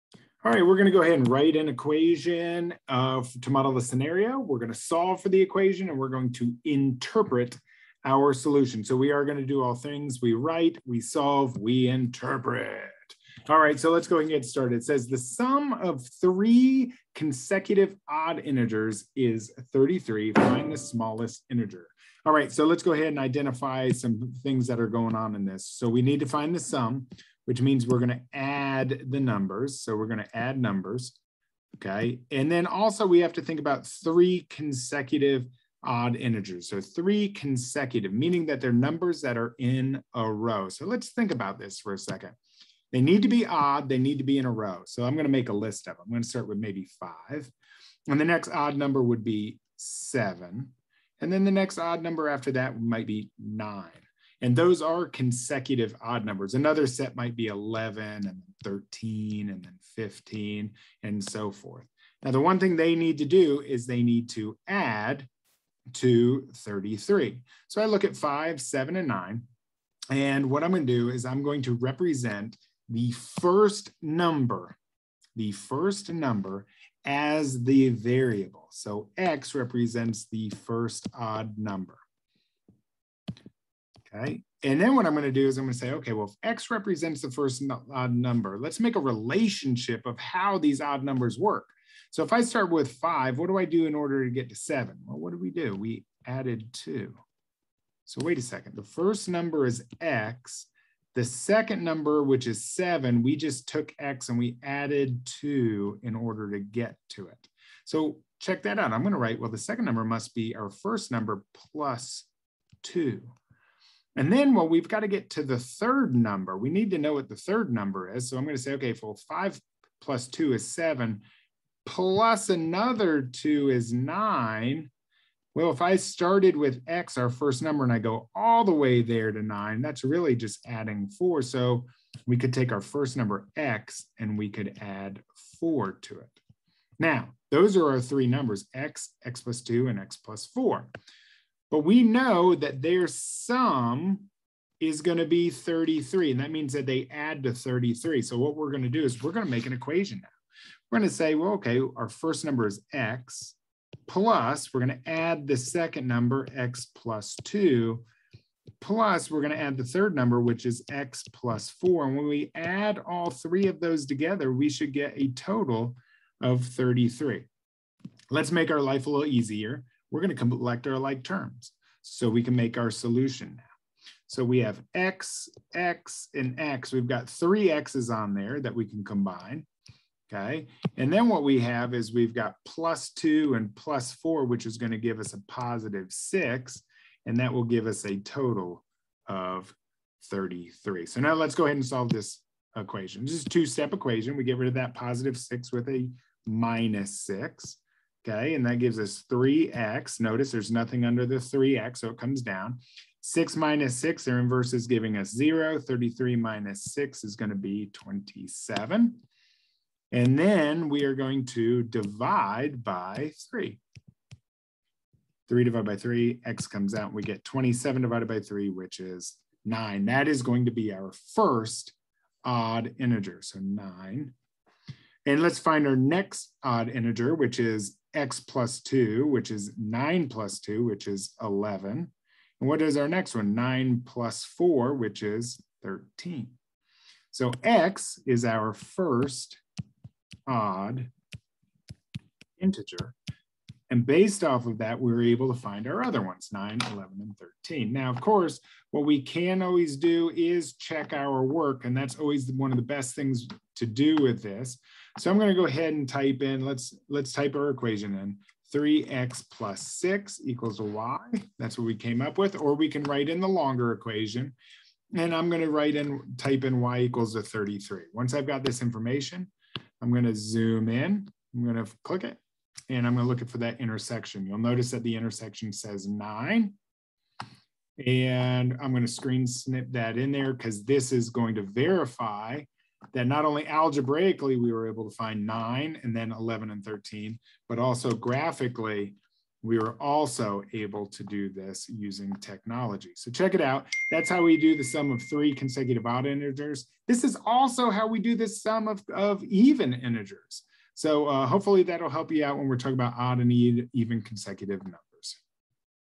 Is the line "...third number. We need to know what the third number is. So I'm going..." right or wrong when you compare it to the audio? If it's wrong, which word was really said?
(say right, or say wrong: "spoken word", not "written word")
right.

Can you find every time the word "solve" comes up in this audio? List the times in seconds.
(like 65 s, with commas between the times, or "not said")
4 s, 10 s, 191 s.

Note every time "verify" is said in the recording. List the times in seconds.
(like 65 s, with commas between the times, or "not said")
281 s.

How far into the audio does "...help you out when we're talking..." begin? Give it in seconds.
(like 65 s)
302 s.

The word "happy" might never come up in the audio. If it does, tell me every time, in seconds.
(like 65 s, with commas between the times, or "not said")
not said.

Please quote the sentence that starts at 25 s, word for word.
So we need to find the sum which means we're going to add the numbers.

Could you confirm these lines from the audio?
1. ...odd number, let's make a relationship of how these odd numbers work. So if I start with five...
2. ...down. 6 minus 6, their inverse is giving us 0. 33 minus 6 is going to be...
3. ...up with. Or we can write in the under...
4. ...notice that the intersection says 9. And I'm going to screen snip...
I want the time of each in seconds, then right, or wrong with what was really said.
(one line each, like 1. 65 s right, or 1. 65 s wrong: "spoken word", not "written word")
1. 87 s right
2. 202 s right
3. 262 s wrong: "longer", not "under"
4. 274 s right.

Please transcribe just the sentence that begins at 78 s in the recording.
So X represents the first odd number okay?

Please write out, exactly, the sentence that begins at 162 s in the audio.
And when we add all three of those together, we should get a total of 33.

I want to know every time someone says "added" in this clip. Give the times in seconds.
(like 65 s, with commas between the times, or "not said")
96 s, 104 s.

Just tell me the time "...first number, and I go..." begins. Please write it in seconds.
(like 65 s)
127 s.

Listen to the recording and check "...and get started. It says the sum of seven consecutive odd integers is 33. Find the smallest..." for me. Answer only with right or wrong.
wrong.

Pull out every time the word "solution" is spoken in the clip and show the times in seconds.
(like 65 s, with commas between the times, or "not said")
8 s, 172 s.